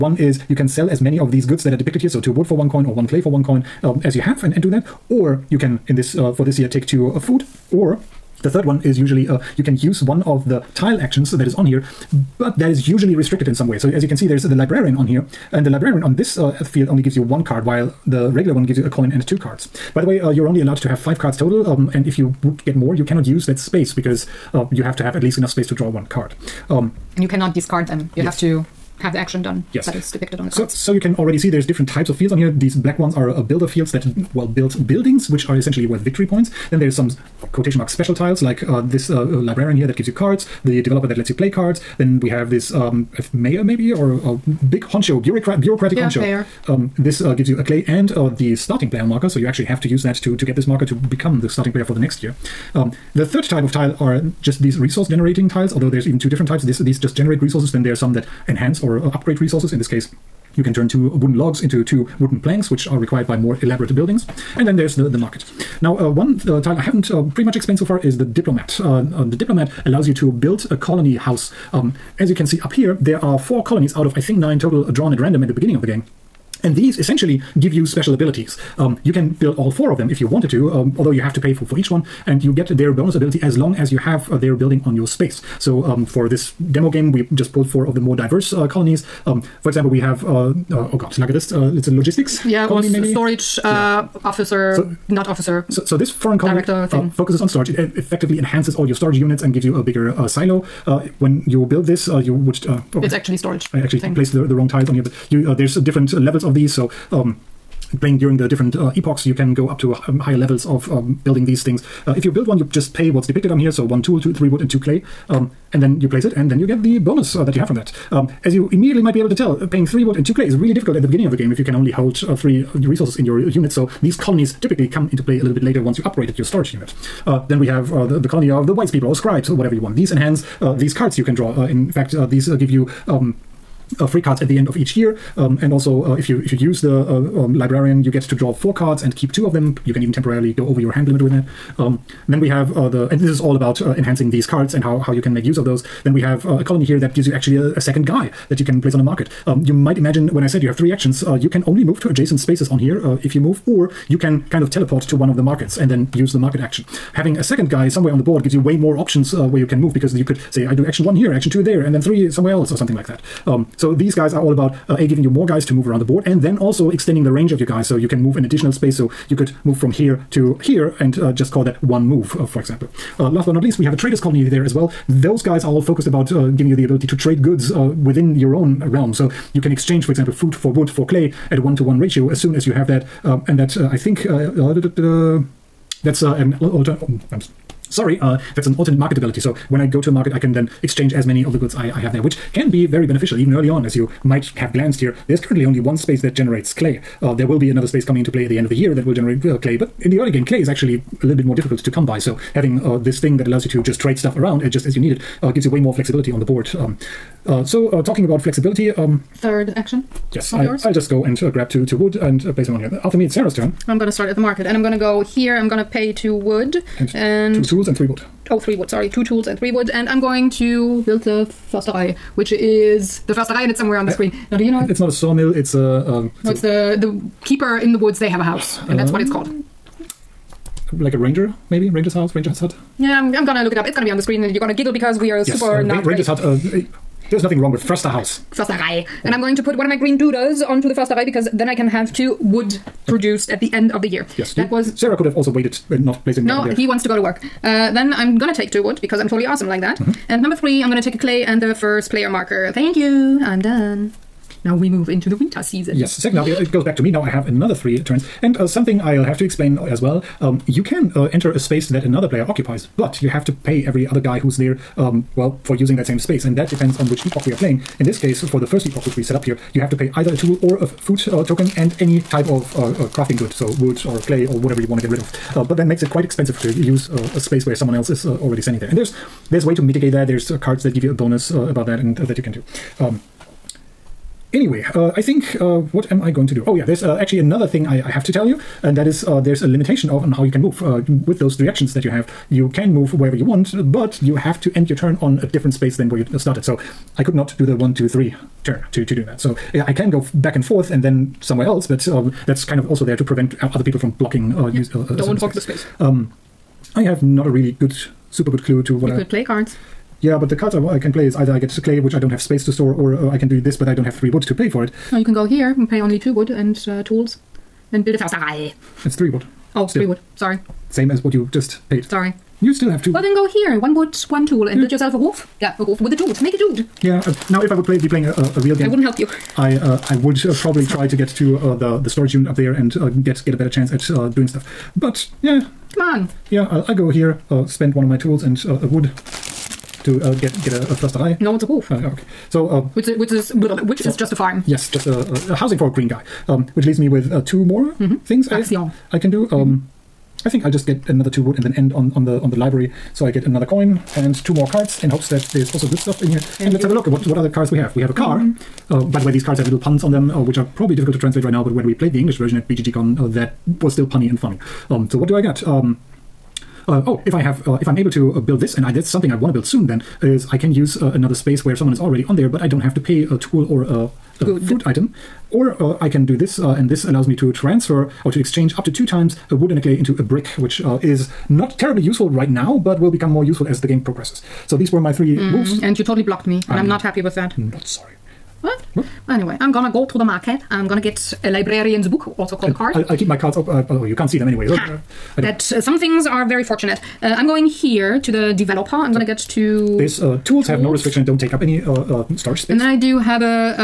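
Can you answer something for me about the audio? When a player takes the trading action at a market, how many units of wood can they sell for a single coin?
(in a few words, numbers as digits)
2.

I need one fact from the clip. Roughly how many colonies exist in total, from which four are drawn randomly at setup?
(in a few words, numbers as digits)
9.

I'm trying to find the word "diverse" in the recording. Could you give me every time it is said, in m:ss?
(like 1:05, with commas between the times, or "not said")
1:28.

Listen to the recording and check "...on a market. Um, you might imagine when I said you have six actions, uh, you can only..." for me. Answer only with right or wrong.
wrong.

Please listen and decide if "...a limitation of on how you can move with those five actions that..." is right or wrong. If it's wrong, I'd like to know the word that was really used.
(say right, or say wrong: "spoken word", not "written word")
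wrong: "three", not "five".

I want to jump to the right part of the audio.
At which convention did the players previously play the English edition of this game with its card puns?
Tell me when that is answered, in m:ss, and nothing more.
6:02.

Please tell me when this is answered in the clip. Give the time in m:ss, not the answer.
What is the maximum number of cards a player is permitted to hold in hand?
0:20.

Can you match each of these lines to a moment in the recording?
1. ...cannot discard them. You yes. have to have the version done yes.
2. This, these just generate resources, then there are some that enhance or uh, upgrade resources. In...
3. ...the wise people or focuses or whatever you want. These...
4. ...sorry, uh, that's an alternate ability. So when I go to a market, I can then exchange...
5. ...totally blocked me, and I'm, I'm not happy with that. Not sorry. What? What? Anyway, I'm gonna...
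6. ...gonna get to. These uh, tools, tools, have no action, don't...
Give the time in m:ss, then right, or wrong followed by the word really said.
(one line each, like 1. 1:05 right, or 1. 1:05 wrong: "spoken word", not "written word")
1. 0:27 wrong: "action", not "version"
2. 0:56 right
3. 2:08 wrong: "scribes", not "focuses"
4. 3:07 wrong: "marketability", not "ability"
5. 6:26 right
6. 6:39 wrong: "restriction", not "action".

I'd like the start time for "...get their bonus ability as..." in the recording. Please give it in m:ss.
1:22.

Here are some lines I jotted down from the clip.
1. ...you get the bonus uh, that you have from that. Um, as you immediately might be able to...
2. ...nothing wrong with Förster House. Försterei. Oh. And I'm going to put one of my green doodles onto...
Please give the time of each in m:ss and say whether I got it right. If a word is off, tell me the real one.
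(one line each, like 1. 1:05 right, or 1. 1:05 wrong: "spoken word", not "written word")
1. 1:56 right
2. 3:57 right.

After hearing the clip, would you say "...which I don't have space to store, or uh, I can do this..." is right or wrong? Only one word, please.
right.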